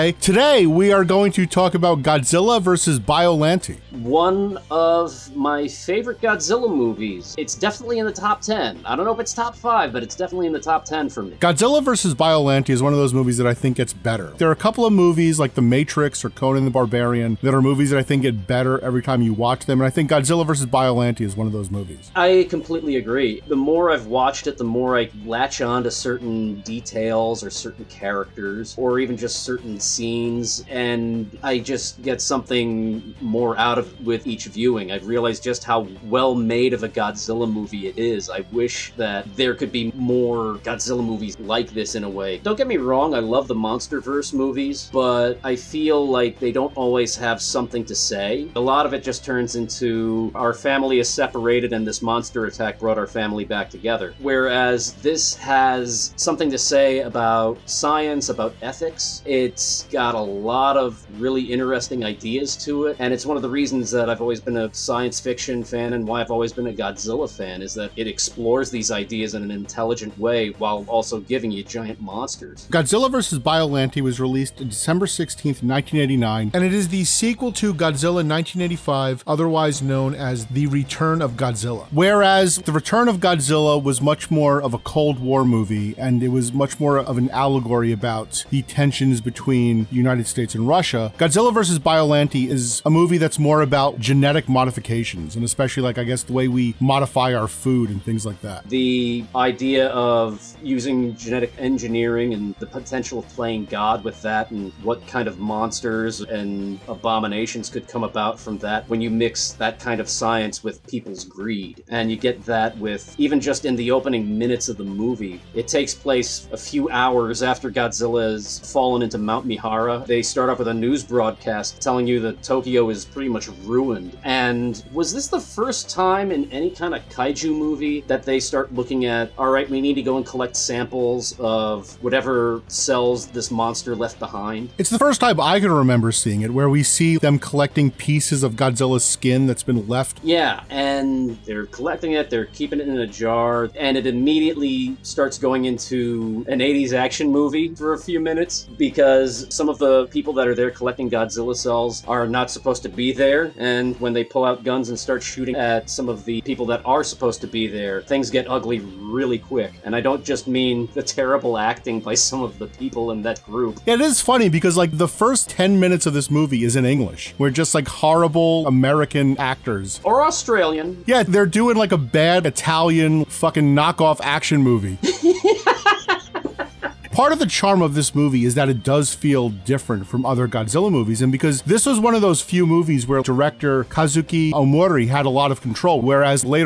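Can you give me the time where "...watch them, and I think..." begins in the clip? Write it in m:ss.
0:19.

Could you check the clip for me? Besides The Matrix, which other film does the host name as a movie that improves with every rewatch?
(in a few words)
Conan the Barbarian.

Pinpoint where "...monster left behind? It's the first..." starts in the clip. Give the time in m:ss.
2:13.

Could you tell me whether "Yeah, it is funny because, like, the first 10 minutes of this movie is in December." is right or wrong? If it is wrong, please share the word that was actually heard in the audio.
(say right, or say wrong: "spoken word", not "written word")
wrong: "English", not "December".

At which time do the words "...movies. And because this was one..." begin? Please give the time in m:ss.
3:00.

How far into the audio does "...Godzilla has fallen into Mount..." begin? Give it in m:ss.
1:57.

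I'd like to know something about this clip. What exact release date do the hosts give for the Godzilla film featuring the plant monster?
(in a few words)
December 16th, 1989.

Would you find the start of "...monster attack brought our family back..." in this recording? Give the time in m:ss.
0:52.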